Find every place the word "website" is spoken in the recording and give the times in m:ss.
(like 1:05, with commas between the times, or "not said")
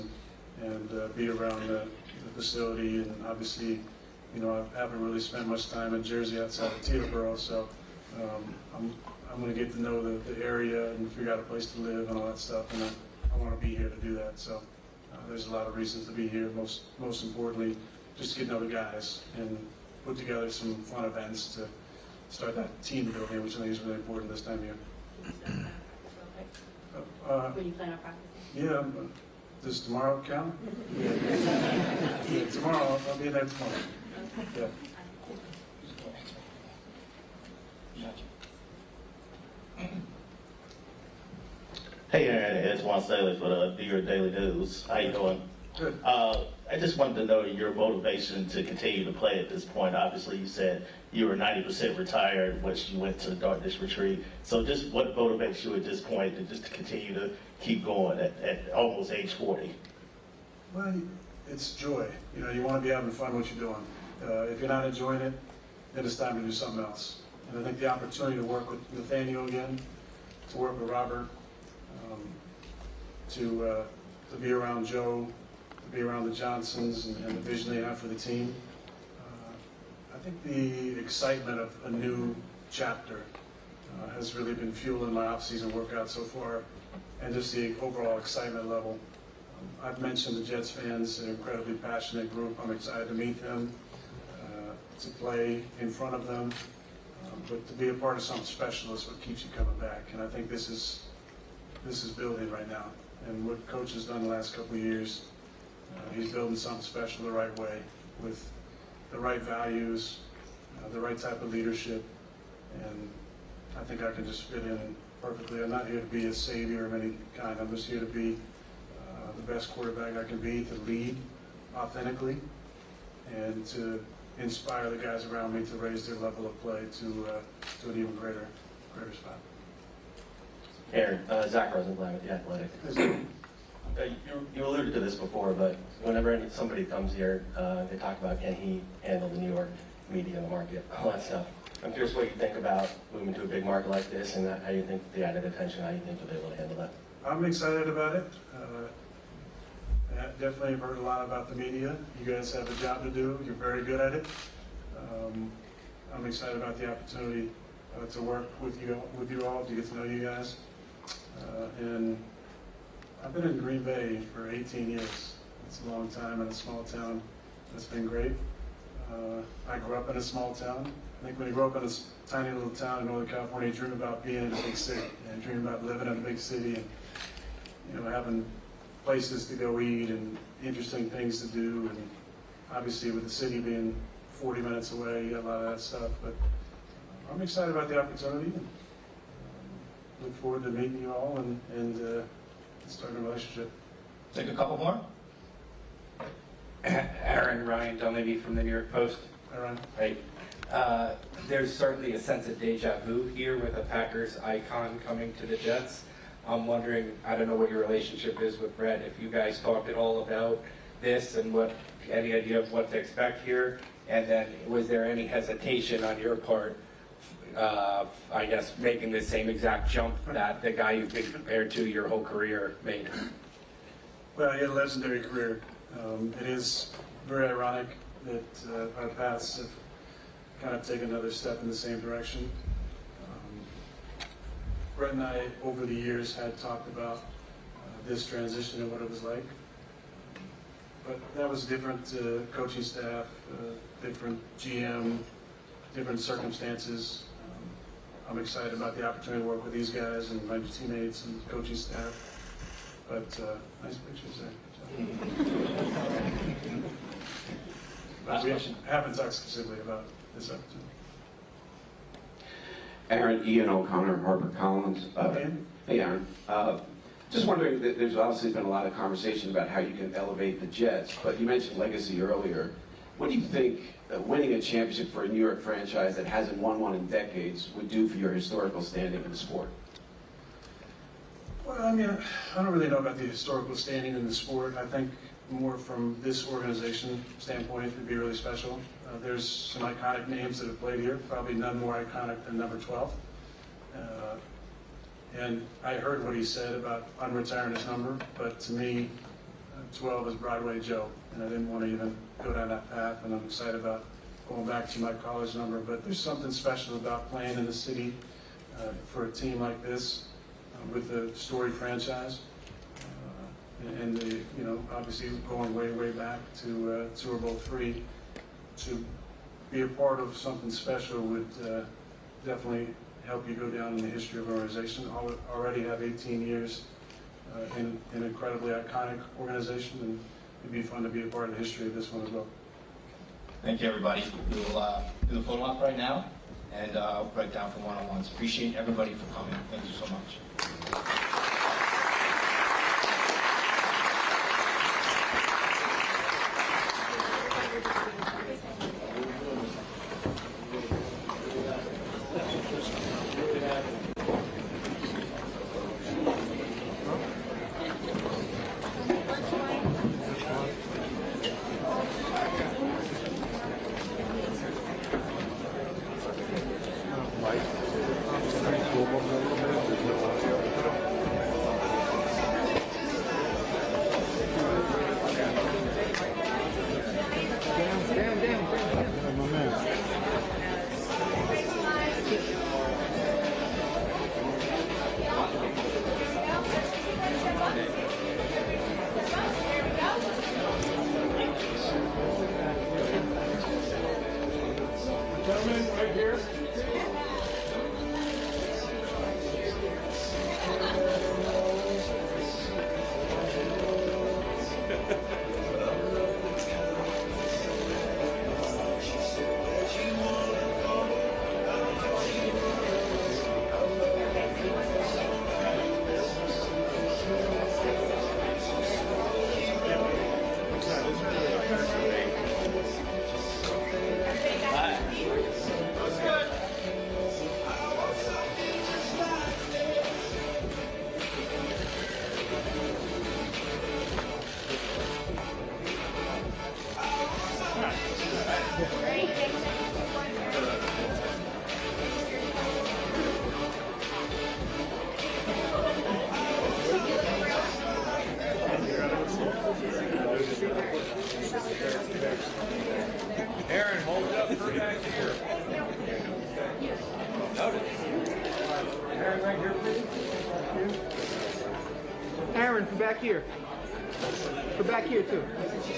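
not said.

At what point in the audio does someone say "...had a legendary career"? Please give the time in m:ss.
3:44.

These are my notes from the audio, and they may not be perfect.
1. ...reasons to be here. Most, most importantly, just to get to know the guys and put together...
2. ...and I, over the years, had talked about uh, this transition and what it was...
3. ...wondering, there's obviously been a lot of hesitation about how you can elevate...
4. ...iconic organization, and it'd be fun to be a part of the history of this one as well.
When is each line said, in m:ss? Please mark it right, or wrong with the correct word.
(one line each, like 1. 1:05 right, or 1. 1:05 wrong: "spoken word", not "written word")
1. 0:15 right
2. 3:55 right
3. 4:27 wrong: "conversation", not "hesitation"
4. 5:28 right.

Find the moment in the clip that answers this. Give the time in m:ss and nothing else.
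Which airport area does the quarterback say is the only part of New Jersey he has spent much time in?
0:06.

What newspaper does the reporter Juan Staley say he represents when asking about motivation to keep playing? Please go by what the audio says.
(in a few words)
Your Daily News.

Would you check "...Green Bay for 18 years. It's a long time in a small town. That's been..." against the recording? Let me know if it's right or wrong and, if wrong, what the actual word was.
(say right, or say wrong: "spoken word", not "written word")
right.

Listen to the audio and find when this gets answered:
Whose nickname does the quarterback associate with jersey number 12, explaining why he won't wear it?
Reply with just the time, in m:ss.
5:00.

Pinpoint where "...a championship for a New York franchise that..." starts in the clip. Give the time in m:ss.
4:34.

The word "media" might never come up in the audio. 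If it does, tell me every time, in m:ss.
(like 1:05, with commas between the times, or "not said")
2:20, 2:31.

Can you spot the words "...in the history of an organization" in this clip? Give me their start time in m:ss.
5:23.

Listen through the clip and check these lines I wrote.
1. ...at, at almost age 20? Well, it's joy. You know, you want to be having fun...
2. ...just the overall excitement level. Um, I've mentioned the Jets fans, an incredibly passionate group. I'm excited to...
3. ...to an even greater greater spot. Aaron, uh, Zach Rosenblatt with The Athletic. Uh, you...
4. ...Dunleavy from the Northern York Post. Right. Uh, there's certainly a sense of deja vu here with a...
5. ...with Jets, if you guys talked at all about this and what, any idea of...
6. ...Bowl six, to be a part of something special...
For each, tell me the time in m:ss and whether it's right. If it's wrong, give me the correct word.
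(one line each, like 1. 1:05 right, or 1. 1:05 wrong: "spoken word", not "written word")
1. 0:58 wrong: "40", not "20"
2. 1:27 right
3. 2:07 right
4. 3:17 wrong: "New", not "Northern"
5. 3:28 wrong: "Brett", not "Jets"
6. 5:17 wrong: "three", not "six".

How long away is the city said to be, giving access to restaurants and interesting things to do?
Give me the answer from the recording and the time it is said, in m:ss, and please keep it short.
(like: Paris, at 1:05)
40 minutes, at 3:04.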